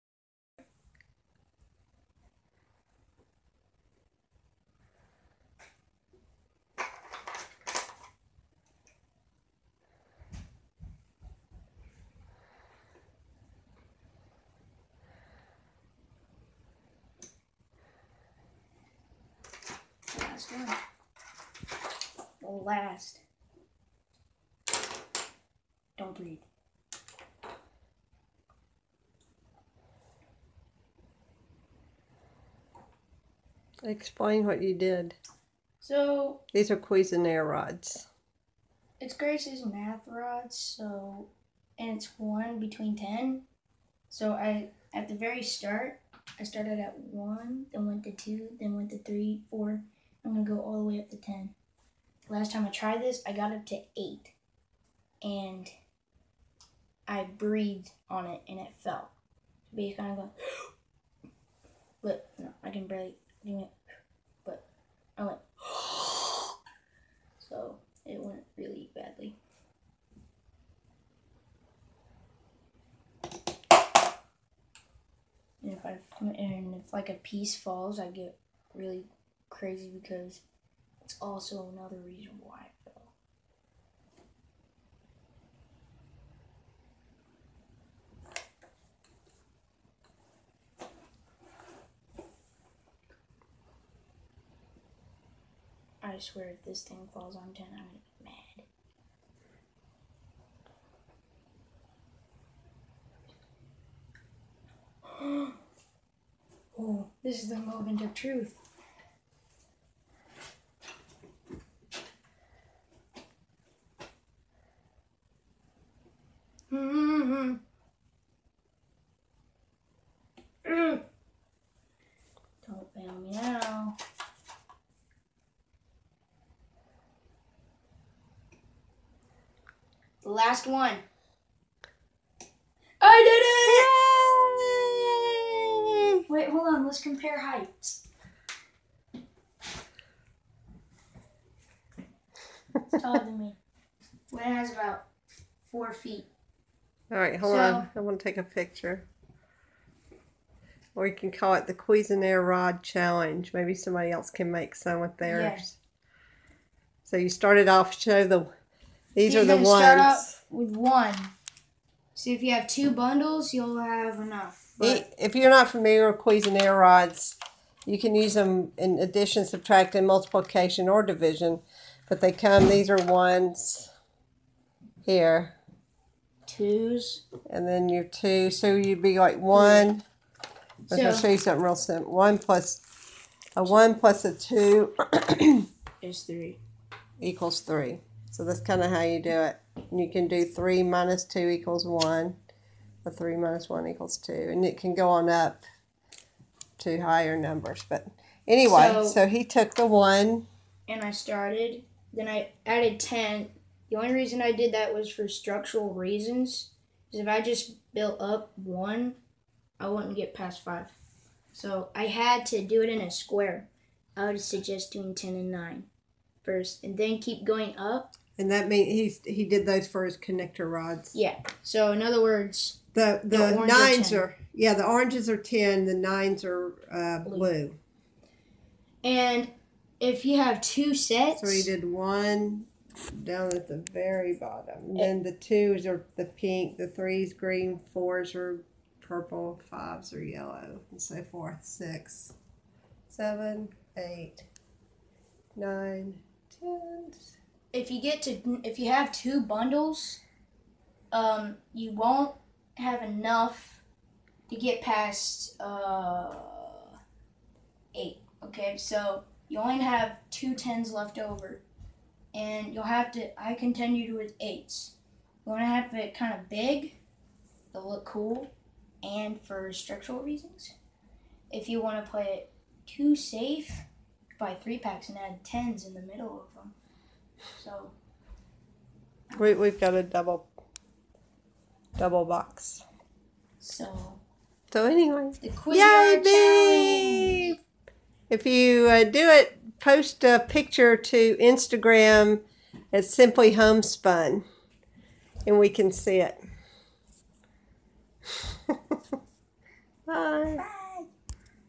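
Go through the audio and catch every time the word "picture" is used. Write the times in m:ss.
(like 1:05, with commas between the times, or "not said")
2:28, 4:50.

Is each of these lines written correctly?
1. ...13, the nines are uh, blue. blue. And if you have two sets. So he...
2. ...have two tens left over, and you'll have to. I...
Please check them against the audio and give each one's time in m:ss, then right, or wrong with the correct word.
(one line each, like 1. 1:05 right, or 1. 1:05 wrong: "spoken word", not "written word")
1. 3:45 wrong: "10", not "13"
2. 4:19 right.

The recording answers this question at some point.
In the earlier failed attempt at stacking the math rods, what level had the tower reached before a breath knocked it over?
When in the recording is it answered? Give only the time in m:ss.
0:53.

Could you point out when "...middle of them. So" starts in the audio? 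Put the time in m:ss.
4:36.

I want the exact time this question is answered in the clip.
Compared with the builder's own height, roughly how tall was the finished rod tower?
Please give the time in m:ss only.
2:24.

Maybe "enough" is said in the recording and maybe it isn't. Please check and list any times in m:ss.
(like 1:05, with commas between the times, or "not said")
2:44, 4:13.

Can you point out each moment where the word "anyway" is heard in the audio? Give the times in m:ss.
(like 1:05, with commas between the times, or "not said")
3:18, 4:44.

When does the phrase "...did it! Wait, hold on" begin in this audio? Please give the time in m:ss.
2:16.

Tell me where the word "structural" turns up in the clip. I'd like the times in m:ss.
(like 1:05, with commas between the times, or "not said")
3:25, 4:29.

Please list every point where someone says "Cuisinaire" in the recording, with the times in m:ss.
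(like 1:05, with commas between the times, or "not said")
0:36, 2:31, 2:46.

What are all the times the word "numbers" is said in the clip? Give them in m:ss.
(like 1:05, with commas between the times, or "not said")
3:17.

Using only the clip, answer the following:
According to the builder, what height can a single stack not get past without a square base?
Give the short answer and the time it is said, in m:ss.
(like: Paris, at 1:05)
5, at 3:29.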